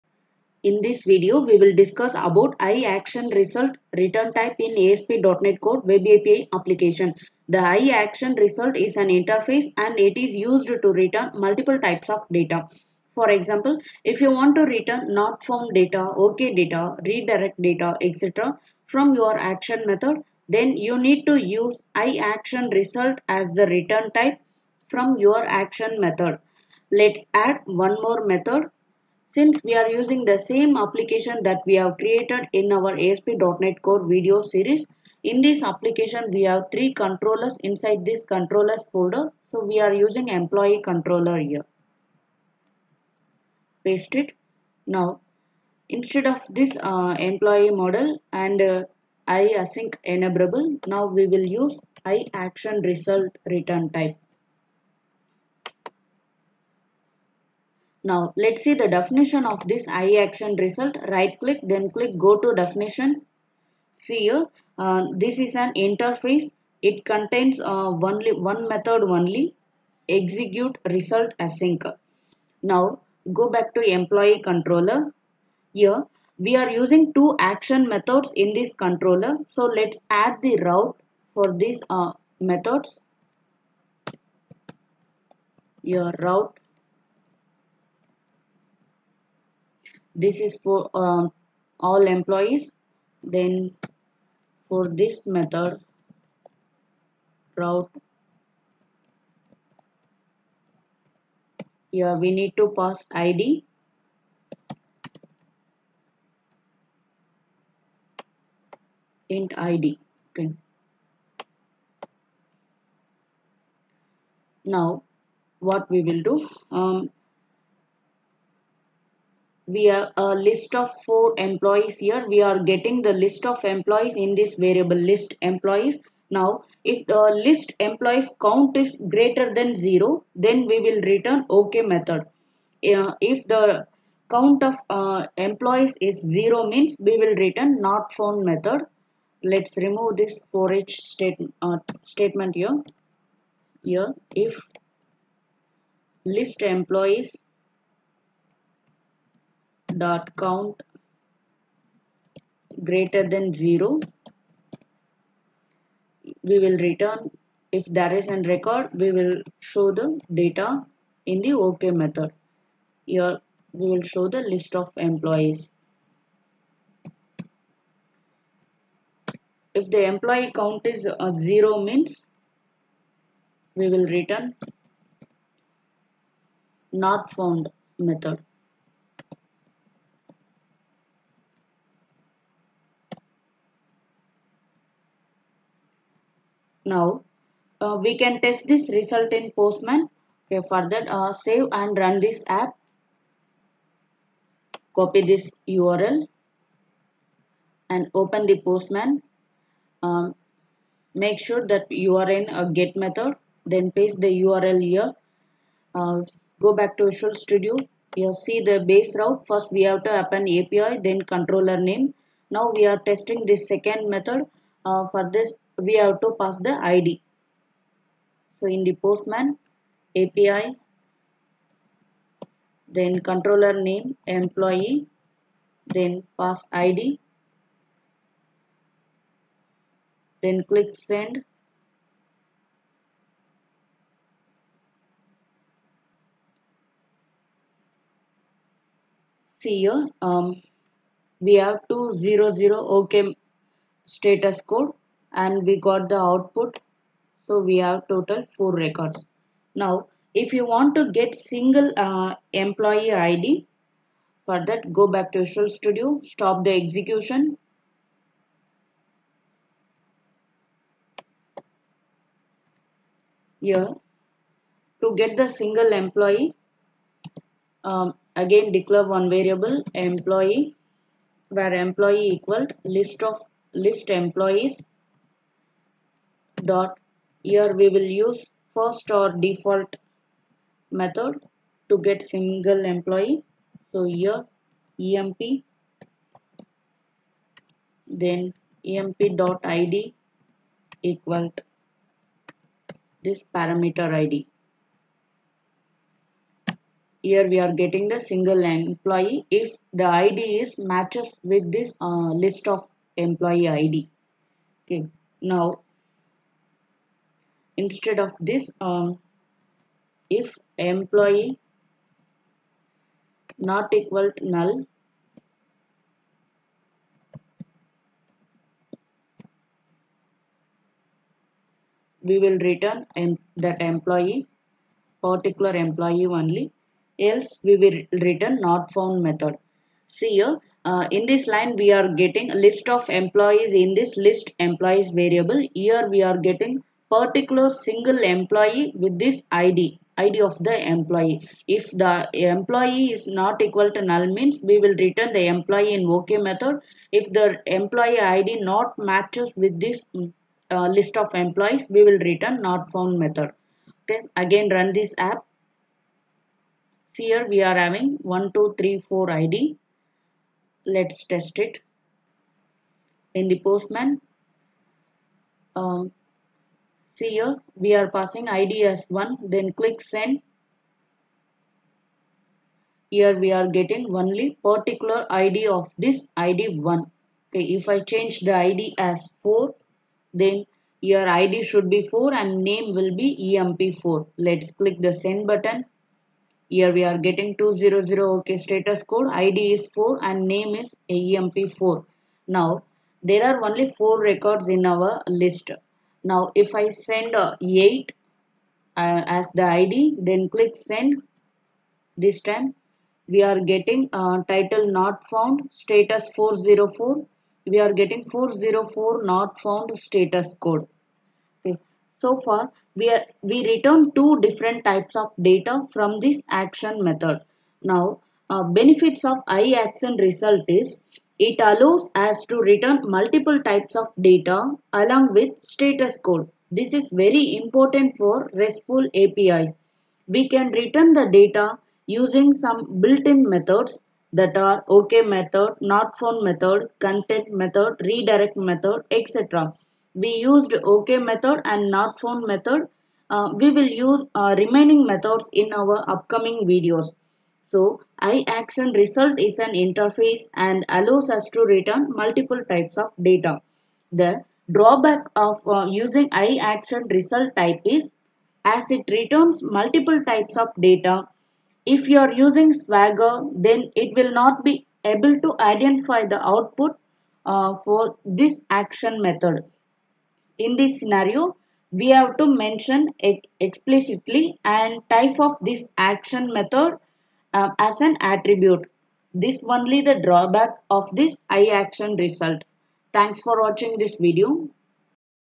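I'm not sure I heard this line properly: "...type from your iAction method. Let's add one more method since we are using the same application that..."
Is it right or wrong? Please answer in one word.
wrong.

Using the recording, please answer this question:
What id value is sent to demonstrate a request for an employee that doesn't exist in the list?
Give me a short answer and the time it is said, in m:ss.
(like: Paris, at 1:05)
8, at 6:37.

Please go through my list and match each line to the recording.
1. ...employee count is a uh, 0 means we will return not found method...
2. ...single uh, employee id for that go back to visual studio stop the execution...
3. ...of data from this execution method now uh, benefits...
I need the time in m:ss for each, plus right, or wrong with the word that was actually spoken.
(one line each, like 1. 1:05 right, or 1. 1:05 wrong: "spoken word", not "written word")
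1. 2:50 right
2. 4:11 right
3. 6:55 wrong: "action", not "execution".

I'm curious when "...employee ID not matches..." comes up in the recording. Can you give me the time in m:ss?
5:47.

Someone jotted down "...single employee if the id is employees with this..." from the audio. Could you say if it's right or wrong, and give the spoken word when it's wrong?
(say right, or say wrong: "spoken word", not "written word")
wrong: "matches", not "employees".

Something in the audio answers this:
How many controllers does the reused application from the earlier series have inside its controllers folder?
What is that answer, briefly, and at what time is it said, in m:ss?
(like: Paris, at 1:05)
3, at 0:36.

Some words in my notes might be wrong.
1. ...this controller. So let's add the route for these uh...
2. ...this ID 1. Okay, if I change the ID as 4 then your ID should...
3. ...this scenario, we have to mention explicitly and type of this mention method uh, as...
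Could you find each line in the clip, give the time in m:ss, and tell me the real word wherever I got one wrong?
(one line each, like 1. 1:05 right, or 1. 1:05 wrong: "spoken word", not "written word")
1. 1:18 right
2. 6:15 right
3. 7:50 wrong: "action", not "mention".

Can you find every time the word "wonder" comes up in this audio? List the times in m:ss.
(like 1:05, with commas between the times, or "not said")
not said.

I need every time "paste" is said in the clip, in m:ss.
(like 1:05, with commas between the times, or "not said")
0:43, 3:23.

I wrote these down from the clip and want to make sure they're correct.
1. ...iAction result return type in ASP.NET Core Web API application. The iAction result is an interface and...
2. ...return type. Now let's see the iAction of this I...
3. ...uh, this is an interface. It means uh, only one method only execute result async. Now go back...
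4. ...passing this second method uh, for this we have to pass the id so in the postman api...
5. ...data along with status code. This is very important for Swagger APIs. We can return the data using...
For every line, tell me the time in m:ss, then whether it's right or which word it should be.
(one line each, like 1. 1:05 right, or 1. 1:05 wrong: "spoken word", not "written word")
1. 0:02 right
2. 0:53 wrong: "definition", not "iAction"
3. 1:04 wrong: "contains", not "means"
4. 3:32 wrong: "testing", not "passing"
5. 7:04 wrong: "RESTful", not "Swagger".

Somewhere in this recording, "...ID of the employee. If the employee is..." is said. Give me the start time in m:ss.
5:40.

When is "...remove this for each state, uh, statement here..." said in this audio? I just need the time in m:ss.
2:19.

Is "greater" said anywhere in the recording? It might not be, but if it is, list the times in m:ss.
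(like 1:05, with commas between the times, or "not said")
2:09, 2:32.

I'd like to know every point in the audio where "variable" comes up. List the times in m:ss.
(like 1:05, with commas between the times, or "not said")
2:04, 4:29, 5:35.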